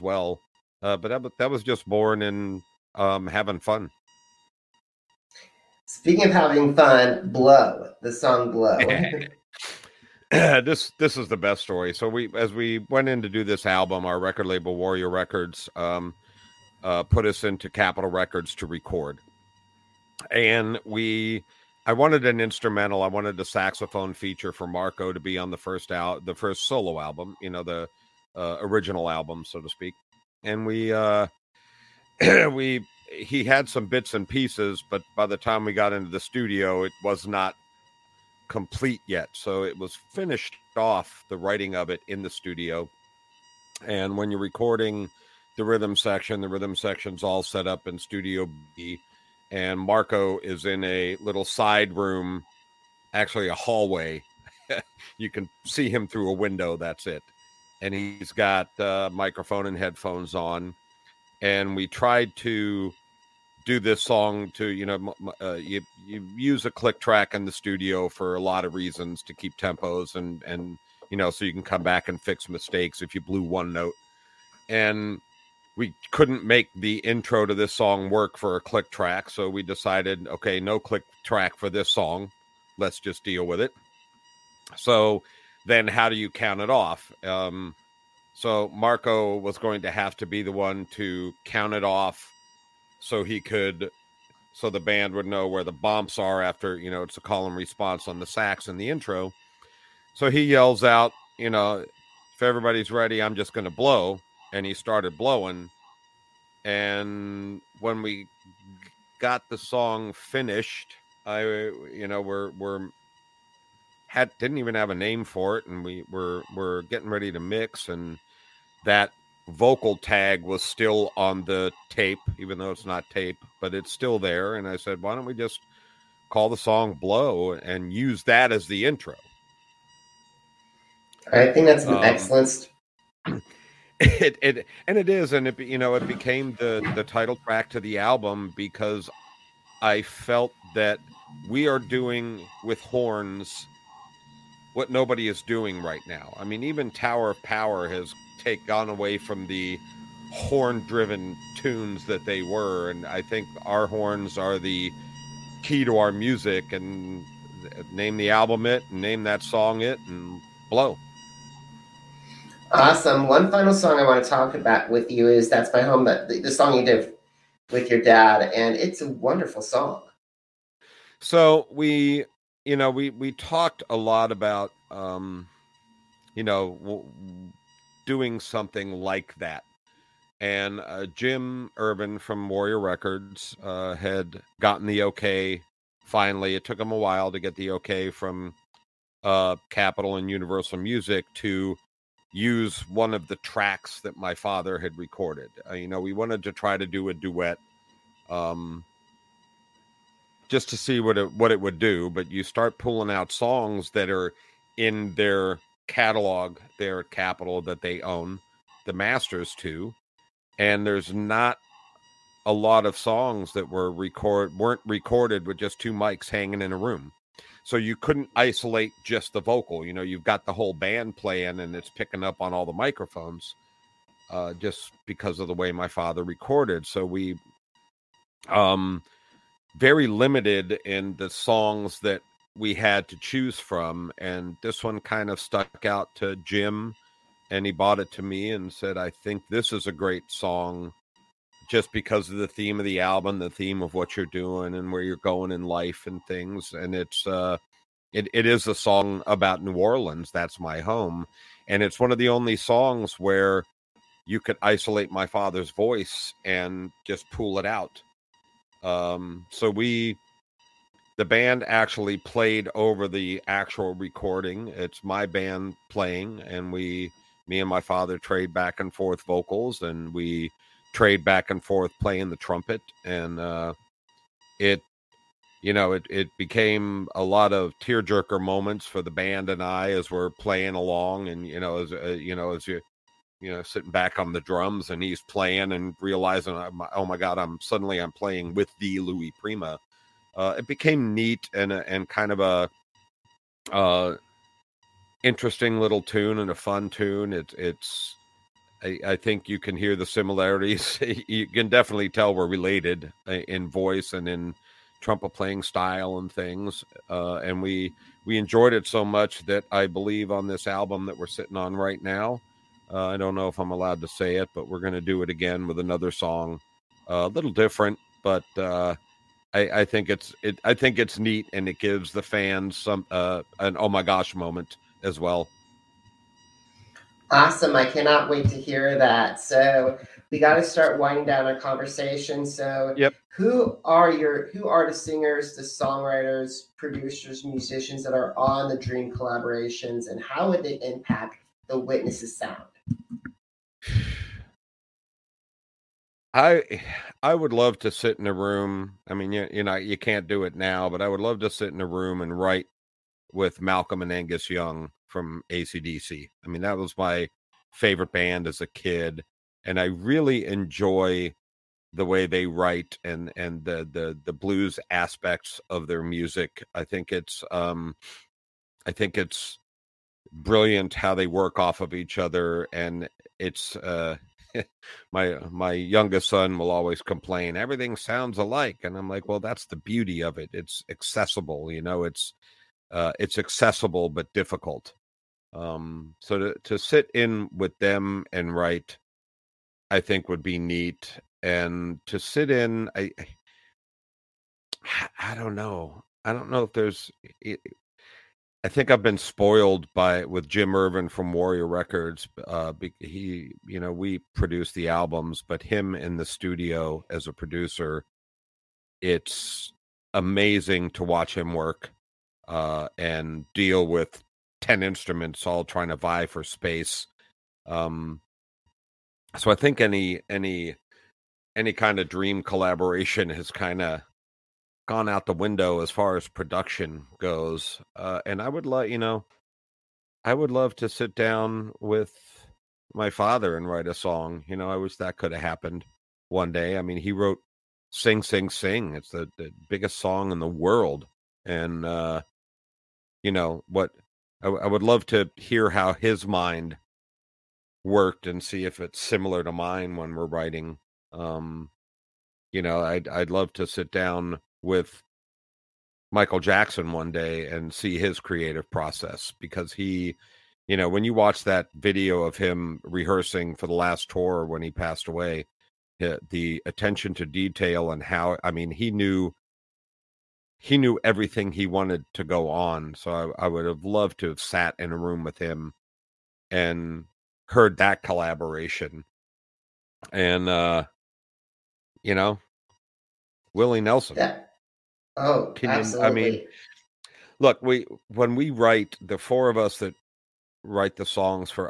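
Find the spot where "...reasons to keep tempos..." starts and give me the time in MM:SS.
01:08.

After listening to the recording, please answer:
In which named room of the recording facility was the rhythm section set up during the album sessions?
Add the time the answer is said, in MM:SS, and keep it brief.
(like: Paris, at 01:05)
Studio B, at 00:47.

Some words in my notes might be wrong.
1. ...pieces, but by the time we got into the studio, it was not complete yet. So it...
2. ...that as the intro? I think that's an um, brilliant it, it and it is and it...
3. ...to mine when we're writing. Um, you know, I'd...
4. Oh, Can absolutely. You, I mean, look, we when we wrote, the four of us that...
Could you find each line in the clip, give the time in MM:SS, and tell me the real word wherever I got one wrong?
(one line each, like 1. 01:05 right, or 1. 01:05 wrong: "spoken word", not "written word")
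1. 00:34 right
2. 02:08 wrong: "excellent", not "brilliant"
3. 07:29 right
4. 08:05 wrong: "write", not "wrote".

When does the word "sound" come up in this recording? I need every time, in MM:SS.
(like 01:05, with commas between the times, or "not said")
05:42, 06:17.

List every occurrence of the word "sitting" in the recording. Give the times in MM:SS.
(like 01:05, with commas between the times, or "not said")
04:43, 05:11.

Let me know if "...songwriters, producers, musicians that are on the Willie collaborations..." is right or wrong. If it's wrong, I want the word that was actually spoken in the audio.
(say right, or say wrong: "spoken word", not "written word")
wrong: "Dream", not "Willie".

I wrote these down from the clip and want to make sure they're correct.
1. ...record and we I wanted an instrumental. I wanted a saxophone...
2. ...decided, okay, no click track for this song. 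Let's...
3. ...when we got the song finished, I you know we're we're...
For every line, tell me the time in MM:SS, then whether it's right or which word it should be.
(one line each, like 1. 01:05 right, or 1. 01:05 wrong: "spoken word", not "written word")
1. 00:18 right
2. 01:19 right
3. 01:47 right.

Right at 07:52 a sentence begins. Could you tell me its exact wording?
So I, I, would have loved to have sat in a room with him and heard that collaboration.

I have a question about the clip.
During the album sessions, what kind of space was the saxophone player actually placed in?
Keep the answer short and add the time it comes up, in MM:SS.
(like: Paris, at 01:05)
A hallway, at 00:53.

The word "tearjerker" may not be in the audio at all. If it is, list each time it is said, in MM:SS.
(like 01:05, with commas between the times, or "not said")
04:37.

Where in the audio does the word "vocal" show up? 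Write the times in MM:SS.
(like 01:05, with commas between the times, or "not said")
01:59, 03:39, 04:29.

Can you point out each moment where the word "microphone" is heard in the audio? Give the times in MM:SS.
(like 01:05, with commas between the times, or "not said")
00:59, 03:42.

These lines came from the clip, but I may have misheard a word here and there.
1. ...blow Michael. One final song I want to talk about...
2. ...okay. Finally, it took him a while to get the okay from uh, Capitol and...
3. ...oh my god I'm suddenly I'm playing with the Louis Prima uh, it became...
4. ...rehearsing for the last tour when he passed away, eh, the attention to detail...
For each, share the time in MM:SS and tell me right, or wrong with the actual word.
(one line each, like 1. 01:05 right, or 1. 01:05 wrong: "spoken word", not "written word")
1. 02:40 wrong: "Awesome", not "Michael"
2. 03:05 right
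3. 04:46 right
4. 07:42 right.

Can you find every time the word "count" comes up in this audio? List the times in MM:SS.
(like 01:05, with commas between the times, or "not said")
01:26, 01:31.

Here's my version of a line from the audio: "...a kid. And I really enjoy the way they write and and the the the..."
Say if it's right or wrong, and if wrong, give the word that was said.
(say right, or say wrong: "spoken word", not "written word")
right.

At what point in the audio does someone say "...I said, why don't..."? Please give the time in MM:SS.
02:04.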